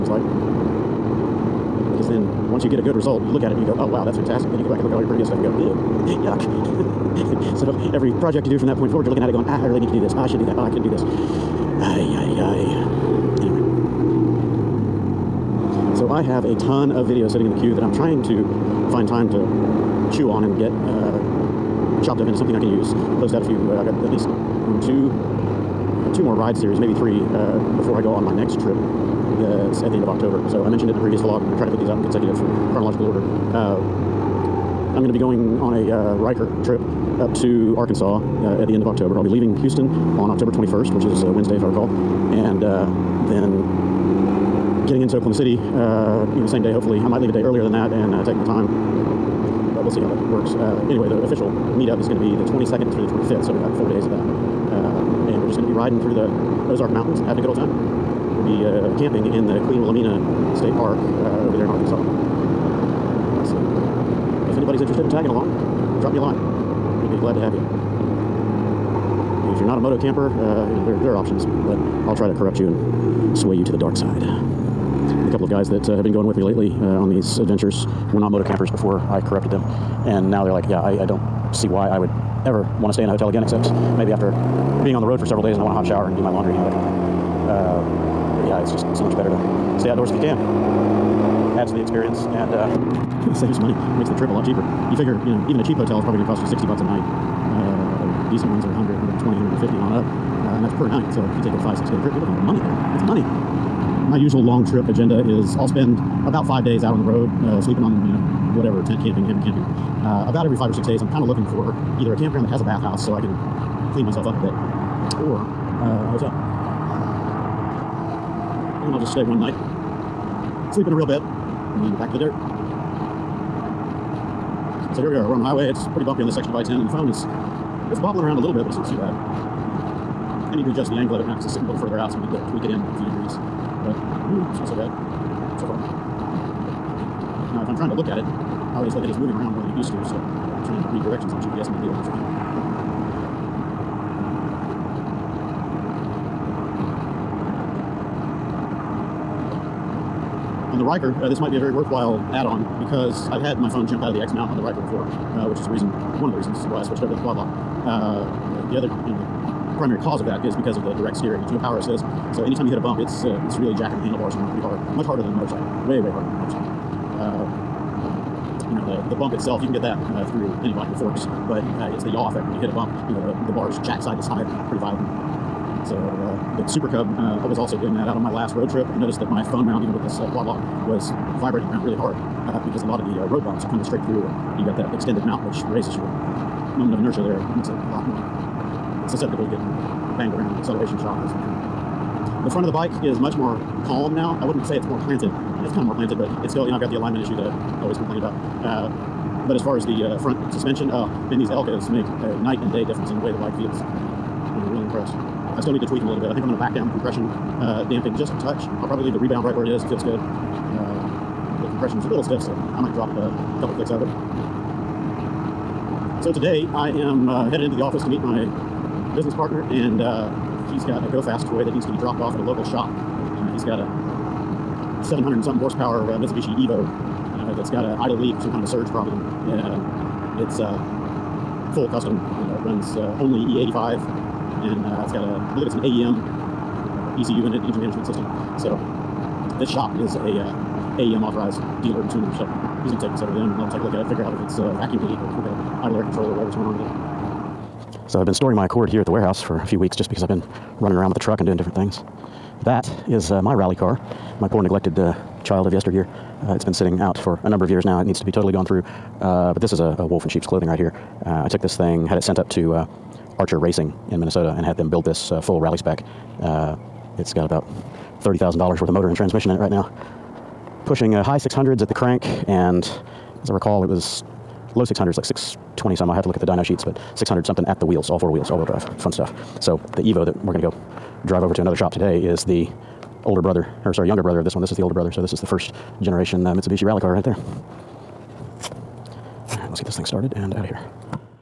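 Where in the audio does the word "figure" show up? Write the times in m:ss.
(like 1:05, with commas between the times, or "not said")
1:34, 4:04.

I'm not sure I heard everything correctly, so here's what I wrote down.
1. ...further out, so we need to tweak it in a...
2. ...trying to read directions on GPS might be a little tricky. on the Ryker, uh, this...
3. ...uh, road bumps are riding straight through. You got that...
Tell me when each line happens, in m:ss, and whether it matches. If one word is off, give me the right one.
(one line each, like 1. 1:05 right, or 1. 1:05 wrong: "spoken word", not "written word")
1. 2:11 right
2. 2:20 right
3. 3:03 wrong: "coming", not "riding".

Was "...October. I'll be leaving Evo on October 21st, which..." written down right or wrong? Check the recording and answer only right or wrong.
wrong.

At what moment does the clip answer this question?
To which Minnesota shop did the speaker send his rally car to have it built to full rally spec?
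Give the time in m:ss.
4:23.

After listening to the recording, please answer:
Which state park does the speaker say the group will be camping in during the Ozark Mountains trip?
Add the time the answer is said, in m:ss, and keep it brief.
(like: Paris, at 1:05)
Queen Wilhelmina State Park, at 0:59.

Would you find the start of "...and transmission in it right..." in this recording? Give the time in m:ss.
4:29.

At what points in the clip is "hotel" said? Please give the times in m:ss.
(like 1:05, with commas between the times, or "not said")
1:23, 1:35, 1:56.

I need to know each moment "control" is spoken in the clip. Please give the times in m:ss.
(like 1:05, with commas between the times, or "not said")
4:06.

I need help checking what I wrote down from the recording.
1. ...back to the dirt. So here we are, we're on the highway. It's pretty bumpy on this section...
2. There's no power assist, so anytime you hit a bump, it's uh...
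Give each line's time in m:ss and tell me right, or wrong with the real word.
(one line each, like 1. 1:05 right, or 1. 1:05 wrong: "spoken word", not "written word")
1. 2:01 right
2. 2:41 right.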